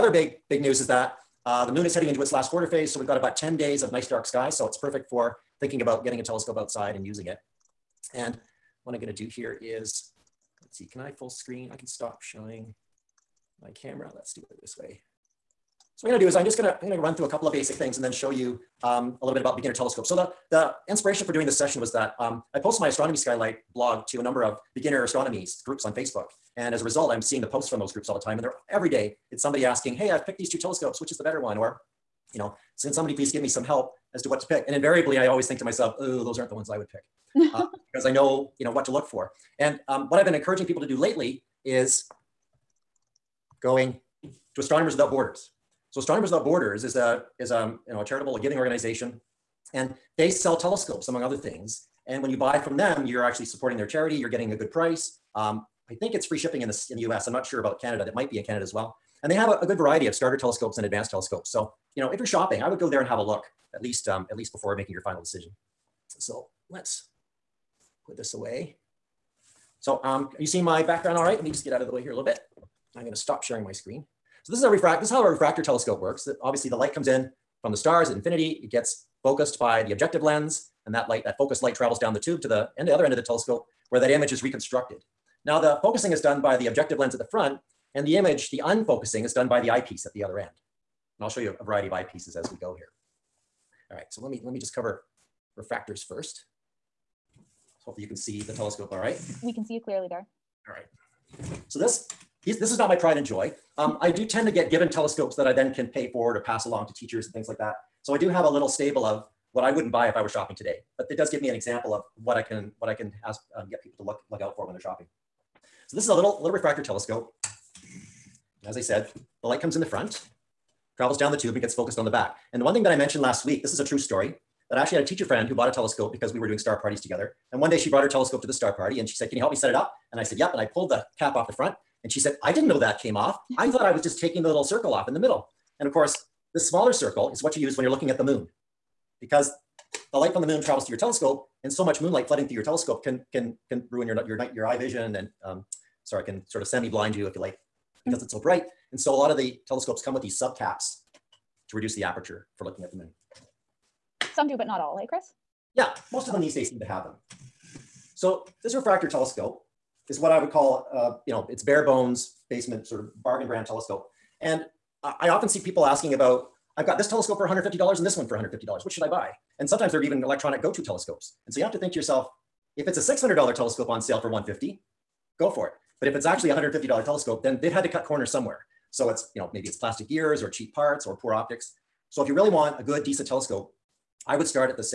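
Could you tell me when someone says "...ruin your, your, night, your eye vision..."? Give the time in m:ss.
2:23.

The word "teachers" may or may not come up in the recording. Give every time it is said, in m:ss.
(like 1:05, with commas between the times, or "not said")
1:46, 2:05.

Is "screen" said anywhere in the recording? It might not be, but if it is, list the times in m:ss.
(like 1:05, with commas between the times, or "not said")
0:11, 1:13.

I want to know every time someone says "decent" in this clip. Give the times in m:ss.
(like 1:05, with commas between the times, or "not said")
3:03.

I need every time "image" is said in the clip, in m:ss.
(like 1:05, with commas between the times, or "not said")
1:24, 1:28.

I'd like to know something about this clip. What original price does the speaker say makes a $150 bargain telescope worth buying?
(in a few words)
$600.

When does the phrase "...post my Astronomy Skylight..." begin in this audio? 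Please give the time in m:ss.
0:22.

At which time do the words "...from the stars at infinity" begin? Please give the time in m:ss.
1:17.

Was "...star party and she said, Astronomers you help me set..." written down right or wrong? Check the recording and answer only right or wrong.
wrong.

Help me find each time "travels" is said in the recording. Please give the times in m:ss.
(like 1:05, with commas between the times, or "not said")
1:21, 2:00, 2:20.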